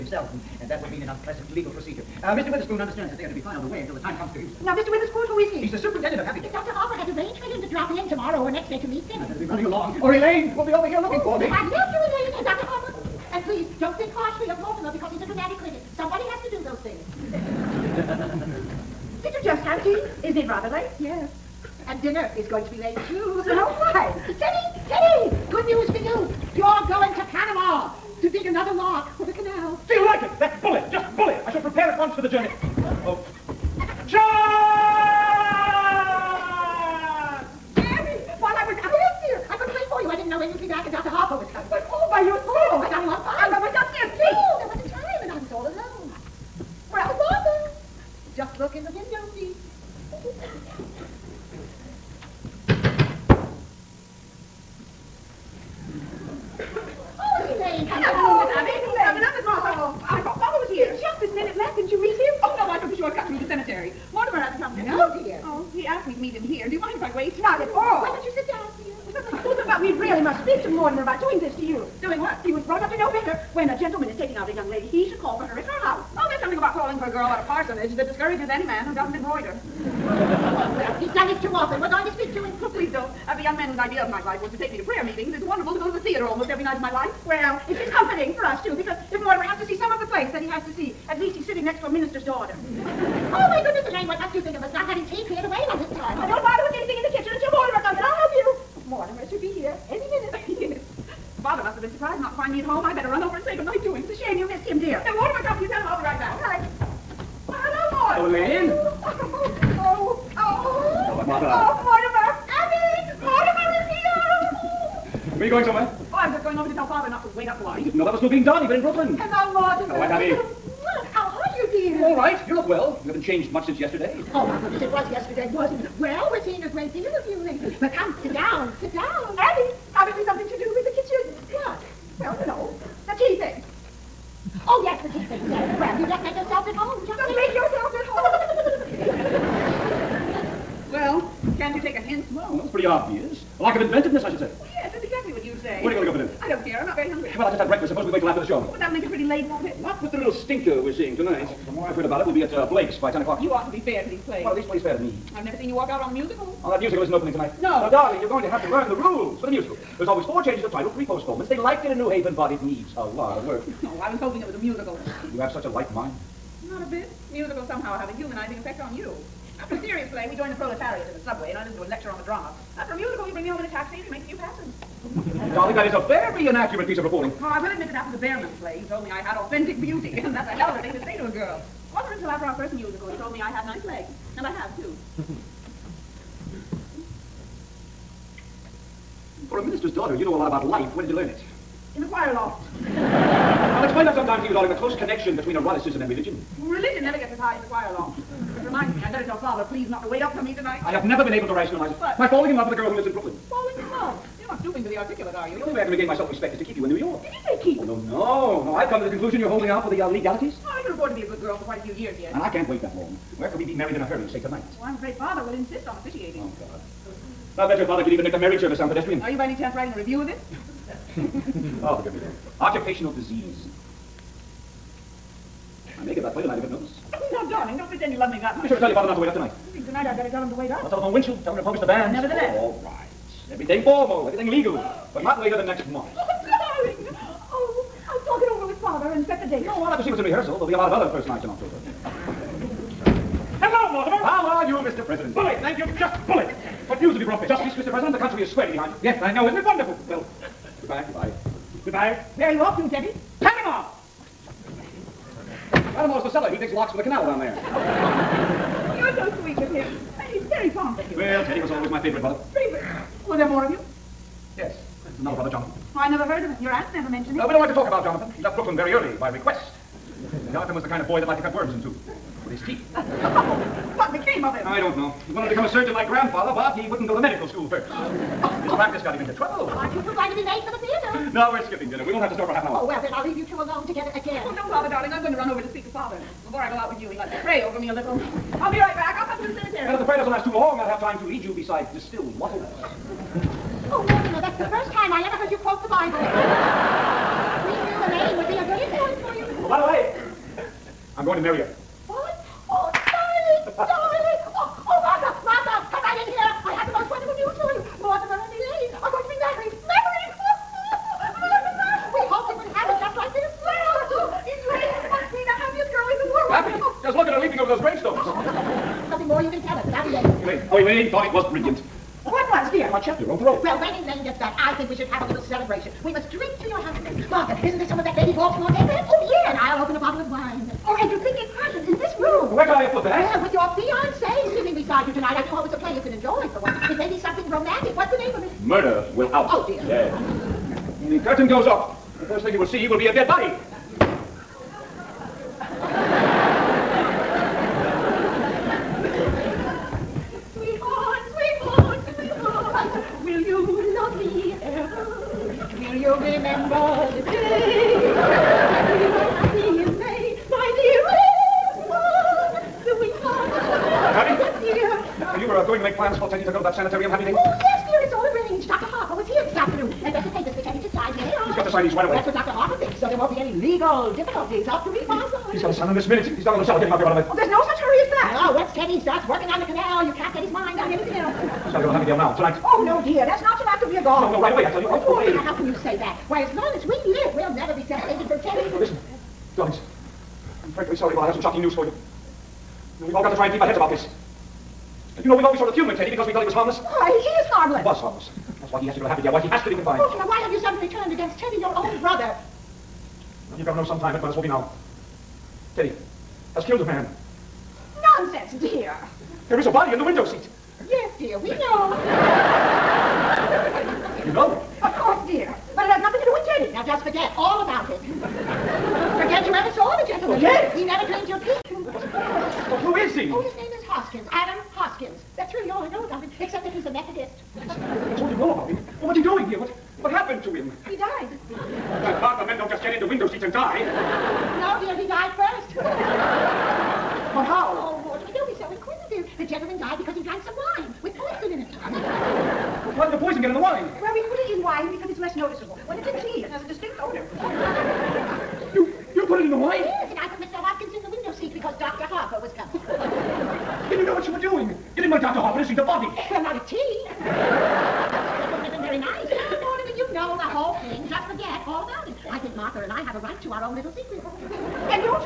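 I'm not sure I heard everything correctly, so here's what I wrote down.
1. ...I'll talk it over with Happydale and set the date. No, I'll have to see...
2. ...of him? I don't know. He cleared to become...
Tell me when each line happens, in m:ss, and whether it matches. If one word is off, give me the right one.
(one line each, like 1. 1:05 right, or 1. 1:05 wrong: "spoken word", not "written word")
1. 3:58 wrong: "Father", not "Happydale"
2. 4:34 wrong: "wanted", not "cleared".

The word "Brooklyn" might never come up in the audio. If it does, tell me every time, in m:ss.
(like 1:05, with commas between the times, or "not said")
1:58, 3:23, 4:28.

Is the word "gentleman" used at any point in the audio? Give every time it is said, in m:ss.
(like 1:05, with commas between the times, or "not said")
7:00, 7:19.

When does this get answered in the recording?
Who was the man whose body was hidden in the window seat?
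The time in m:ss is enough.
7:04.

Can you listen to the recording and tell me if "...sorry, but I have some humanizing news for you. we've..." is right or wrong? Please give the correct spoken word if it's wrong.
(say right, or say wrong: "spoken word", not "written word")
wrong: "shocking", not "humanizing".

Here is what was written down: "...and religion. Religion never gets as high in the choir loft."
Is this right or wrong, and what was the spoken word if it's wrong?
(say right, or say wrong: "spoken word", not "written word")
right.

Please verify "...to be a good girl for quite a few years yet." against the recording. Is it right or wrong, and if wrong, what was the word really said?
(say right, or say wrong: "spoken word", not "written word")
right.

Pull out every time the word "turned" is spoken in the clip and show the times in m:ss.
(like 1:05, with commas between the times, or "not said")
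6:40.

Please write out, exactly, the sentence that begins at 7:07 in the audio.
That's all you know about him?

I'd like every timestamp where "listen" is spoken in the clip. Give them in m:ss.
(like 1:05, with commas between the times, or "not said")
2:51, 6:28.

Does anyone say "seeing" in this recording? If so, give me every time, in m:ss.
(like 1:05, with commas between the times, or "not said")
2:06, 2:30.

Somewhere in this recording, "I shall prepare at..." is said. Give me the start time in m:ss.
0:31.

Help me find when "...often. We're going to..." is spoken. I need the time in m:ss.
1:21.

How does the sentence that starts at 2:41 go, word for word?
They liked it in New Haven, but it needs a lot of work.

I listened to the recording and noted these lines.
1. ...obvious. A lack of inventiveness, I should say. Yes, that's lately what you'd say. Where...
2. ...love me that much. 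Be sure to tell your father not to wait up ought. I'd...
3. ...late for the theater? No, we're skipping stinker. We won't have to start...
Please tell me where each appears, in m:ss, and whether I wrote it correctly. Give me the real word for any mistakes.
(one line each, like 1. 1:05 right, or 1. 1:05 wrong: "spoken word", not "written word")
1. 2:22 wrong: "exactly", not "lately"
2. 3:48 wrong: "tonight", not "ought"
3. 4:40 wrong: "dinner", not "stinker".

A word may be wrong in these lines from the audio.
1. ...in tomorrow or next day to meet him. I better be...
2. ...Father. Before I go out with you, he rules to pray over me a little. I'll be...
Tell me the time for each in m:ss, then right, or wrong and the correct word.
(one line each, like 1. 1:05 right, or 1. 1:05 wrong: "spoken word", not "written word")
1. 0:07 right
2. 4:45 wrong: "likes", not "rules".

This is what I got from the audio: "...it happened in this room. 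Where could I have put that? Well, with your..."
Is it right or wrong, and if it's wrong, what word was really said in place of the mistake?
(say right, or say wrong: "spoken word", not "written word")
right.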